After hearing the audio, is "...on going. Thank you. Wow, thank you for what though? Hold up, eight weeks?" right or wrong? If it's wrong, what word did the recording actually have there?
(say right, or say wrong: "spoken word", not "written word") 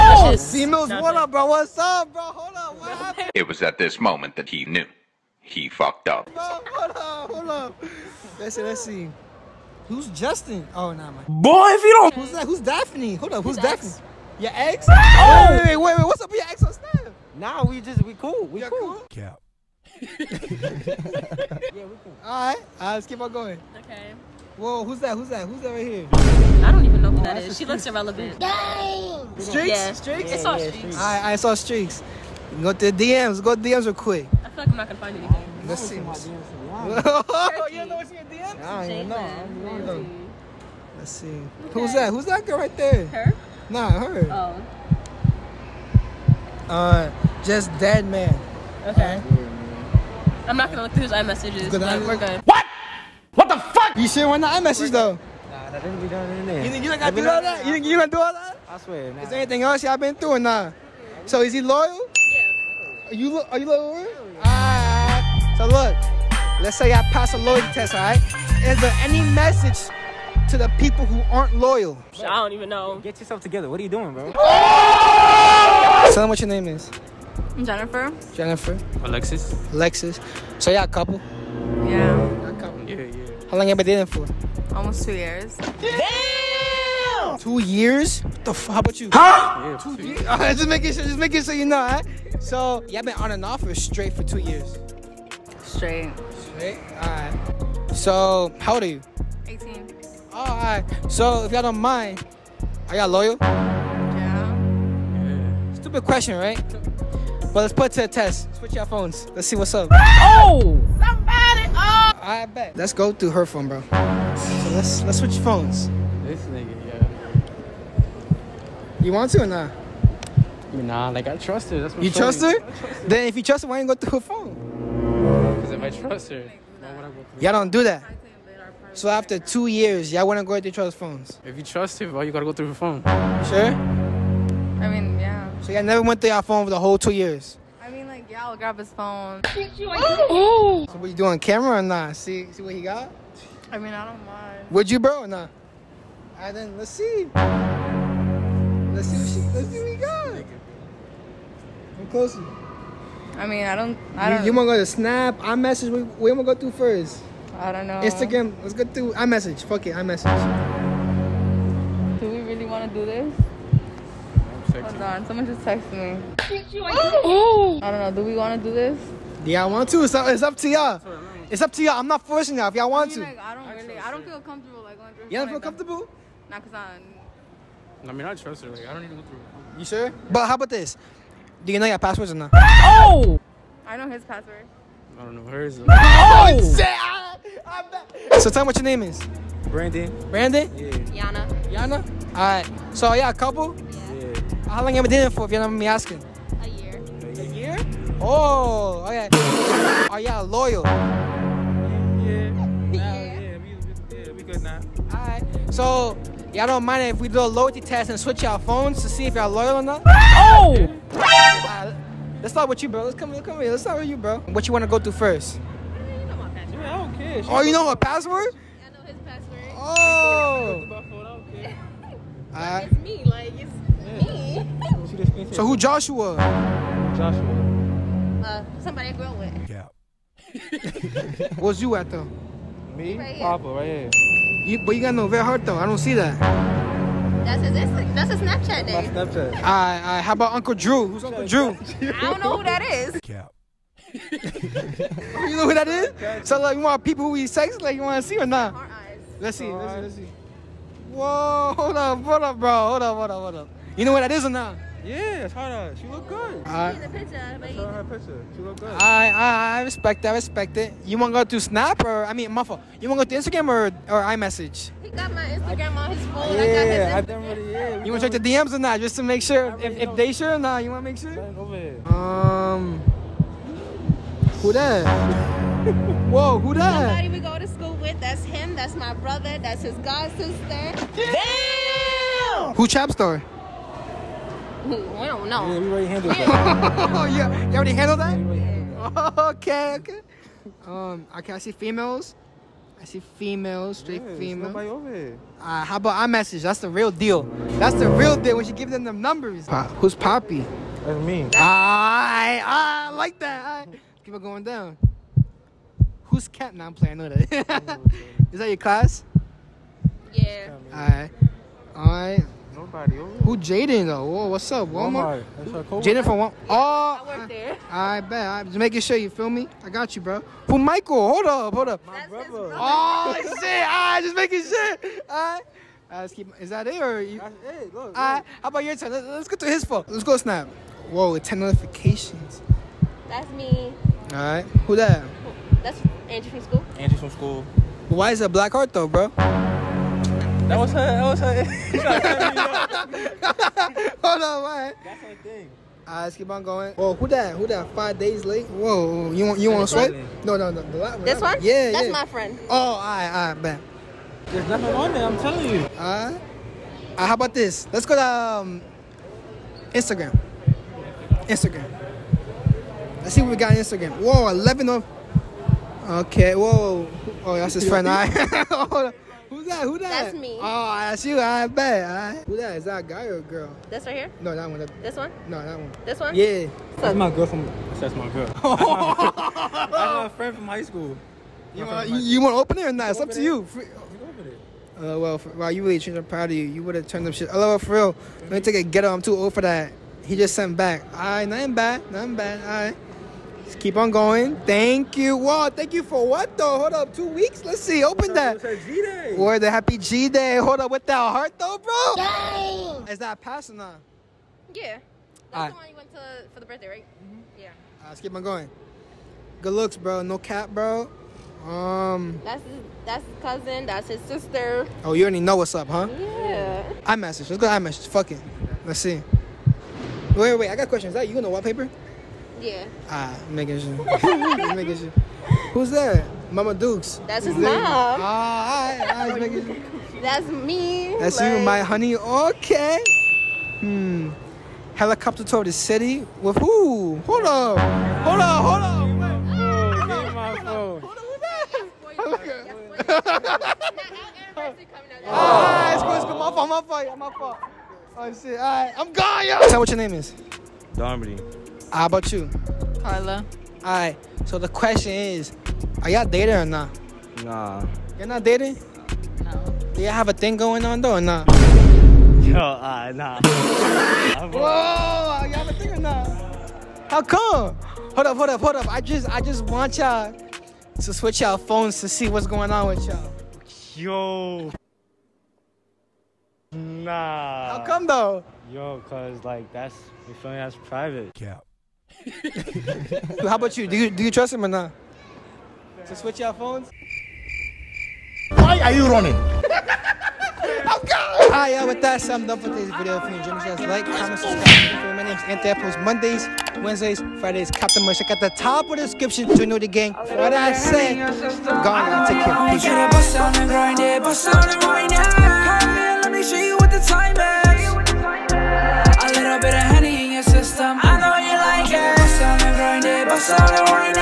wrong: "two", not "eight".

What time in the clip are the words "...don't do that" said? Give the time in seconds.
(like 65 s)
127 s.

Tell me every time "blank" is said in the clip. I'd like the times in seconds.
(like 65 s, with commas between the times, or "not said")
not said.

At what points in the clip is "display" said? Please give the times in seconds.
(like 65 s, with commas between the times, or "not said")
not said.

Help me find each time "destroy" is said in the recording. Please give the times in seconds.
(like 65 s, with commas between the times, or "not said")
not said.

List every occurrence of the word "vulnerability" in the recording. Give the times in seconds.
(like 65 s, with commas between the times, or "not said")
not said.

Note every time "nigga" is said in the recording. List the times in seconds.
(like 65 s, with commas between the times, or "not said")
116 s.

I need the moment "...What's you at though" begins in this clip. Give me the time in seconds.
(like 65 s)
231 s.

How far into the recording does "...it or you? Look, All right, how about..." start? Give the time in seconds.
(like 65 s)
326 s.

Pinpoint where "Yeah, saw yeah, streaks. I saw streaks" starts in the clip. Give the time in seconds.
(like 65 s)
30 s.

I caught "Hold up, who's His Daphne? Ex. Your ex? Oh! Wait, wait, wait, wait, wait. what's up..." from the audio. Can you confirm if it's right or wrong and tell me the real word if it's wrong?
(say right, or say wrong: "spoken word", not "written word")
right.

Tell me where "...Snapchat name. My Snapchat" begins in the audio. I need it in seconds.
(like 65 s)
238 s.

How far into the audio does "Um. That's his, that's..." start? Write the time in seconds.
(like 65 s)
411 s.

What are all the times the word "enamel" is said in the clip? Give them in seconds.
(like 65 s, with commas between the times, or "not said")
not said.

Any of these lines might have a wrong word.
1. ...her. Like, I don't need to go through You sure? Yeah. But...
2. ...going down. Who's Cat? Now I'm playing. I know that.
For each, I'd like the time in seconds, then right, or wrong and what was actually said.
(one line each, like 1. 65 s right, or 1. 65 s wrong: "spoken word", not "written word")
1. 178 s right
2. 304 s right.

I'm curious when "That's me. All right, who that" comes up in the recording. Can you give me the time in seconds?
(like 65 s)
333 s.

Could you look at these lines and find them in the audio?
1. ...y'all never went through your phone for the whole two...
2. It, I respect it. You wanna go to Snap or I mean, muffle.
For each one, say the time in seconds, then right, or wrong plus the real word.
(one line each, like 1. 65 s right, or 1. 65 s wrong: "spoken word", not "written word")
1. 135 s right
2. 260 s right.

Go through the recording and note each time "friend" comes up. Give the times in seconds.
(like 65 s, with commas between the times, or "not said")
352 s, 367 s, 380 s.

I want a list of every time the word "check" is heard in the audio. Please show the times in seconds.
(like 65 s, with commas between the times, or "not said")
268 s, 498 s.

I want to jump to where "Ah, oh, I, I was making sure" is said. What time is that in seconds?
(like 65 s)
427 s.